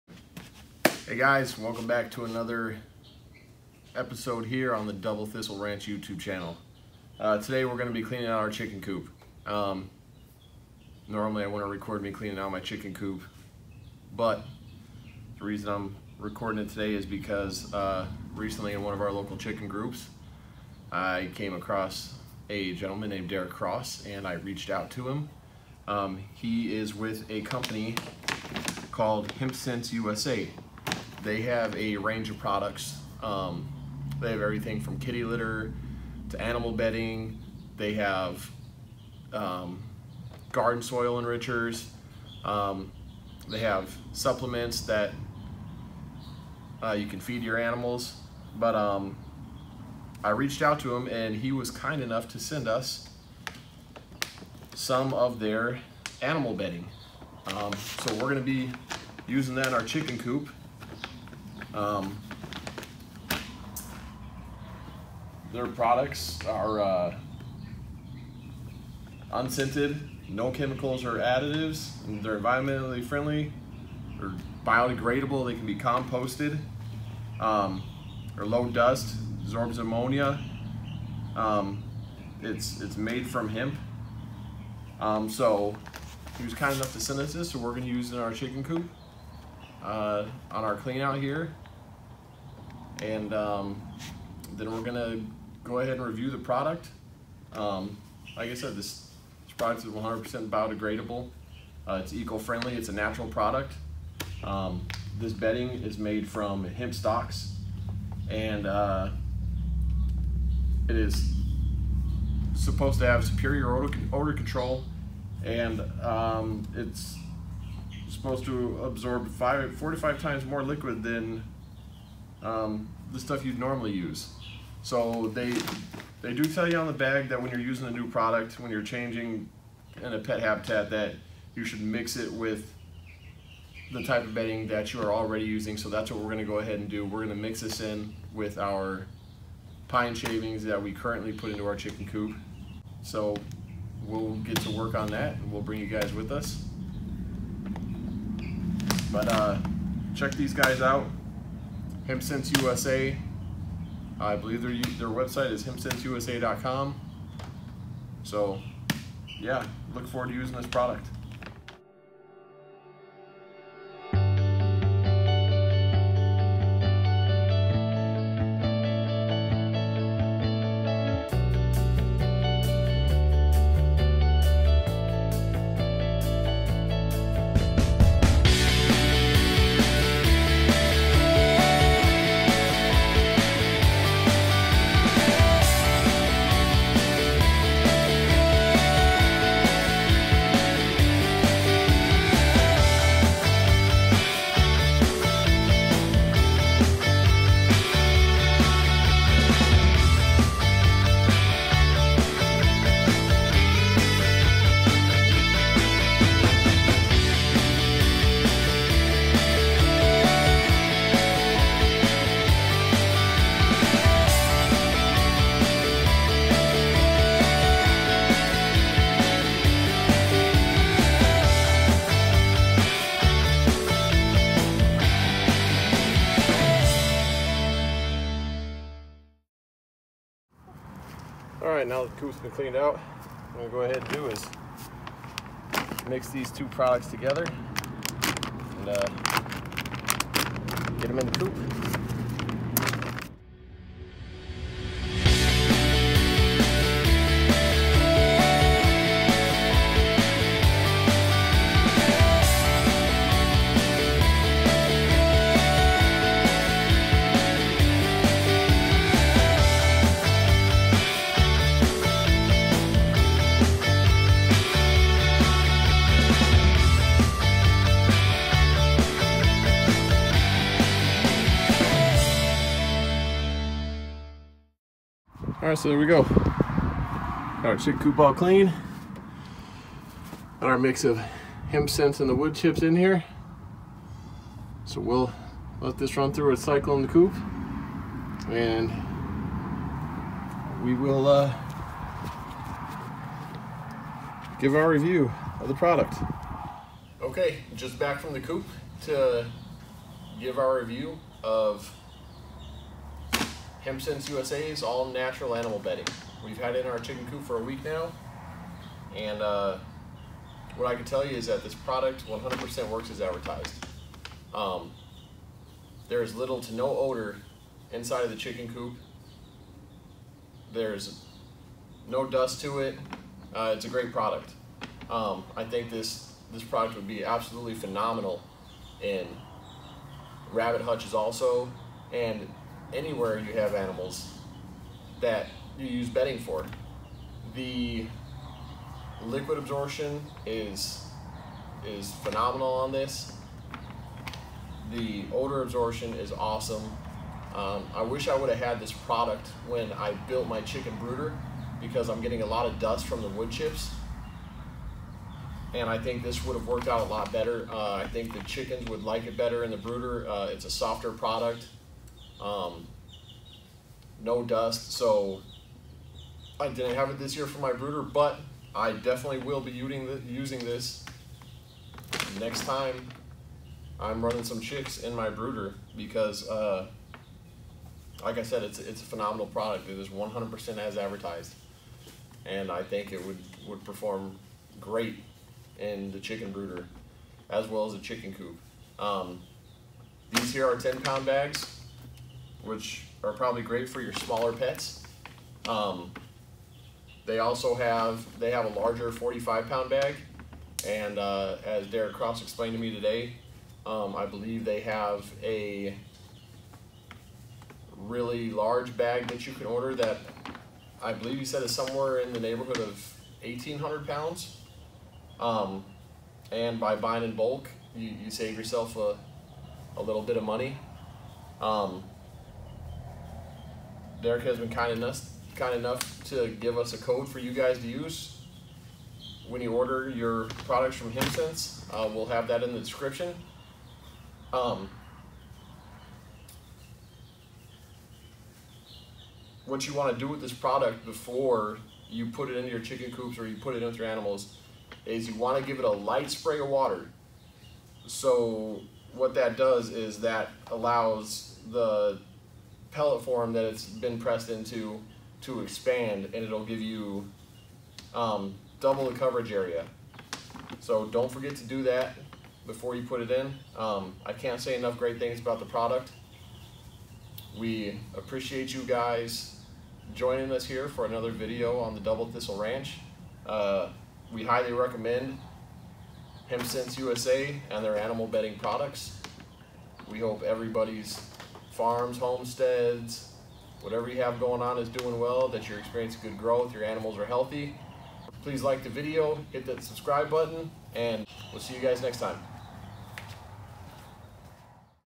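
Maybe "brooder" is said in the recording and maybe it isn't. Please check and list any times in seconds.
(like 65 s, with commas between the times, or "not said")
350 s, 359 s, 367 s, 375 s, 386 s.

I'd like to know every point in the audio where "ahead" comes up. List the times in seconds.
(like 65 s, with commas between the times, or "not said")
95 s, 136 s, 233 s.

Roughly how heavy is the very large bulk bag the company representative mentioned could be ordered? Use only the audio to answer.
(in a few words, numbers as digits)
1,800 pounds.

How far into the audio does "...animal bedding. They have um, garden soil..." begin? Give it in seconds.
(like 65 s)
36 s.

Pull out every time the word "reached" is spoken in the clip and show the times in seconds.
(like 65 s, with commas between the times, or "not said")
24 s, 50 s.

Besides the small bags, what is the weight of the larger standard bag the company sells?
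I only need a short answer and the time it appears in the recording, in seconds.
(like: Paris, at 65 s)
45 pounds, at 399 s.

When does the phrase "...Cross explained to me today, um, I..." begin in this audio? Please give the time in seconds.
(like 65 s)
402 s.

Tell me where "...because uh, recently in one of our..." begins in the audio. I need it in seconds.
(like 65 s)
17 s.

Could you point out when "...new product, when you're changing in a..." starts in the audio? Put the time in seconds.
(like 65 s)
127 s.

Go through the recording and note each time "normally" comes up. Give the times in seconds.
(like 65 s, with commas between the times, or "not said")
11 s, 123 s.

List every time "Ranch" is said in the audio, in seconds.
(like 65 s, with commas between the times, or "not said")
5 s, 472 s.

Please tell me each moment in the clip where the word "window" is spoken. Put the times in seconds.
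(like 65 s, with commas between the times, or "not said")
not said.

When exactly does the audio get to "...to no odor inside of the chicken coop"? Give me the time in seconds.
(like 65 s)
316 s.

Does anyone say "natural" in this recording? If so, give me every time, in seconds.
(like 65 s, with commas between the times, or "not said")
102 s, 305 s.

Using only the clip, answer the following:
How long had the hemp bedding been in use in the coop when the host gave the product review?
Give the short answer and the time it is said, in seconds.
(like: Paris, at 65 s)
a week, at 307 s.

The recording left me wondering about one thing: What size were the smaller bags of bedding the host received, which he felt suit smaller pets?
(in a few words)
10 pound.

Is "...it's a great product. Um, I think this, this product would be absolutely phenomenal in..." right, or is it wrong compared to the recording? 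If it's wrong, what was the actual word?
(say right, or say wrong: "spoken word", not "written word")
right.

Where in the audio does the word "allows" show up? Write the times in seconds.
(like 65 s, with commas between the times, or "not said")
450 s.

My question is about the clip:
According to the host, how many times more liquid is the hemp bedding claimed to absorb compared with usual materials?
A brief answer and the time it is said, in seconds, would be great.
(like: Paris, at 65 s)
4 to 5 times, at 119 s.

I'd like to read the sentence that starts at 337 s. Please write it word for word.
The liquid absorption is is phenomenal on this.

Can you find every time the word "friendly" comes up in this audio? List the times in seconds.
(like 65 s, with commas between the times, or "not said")
73 s, 102 s.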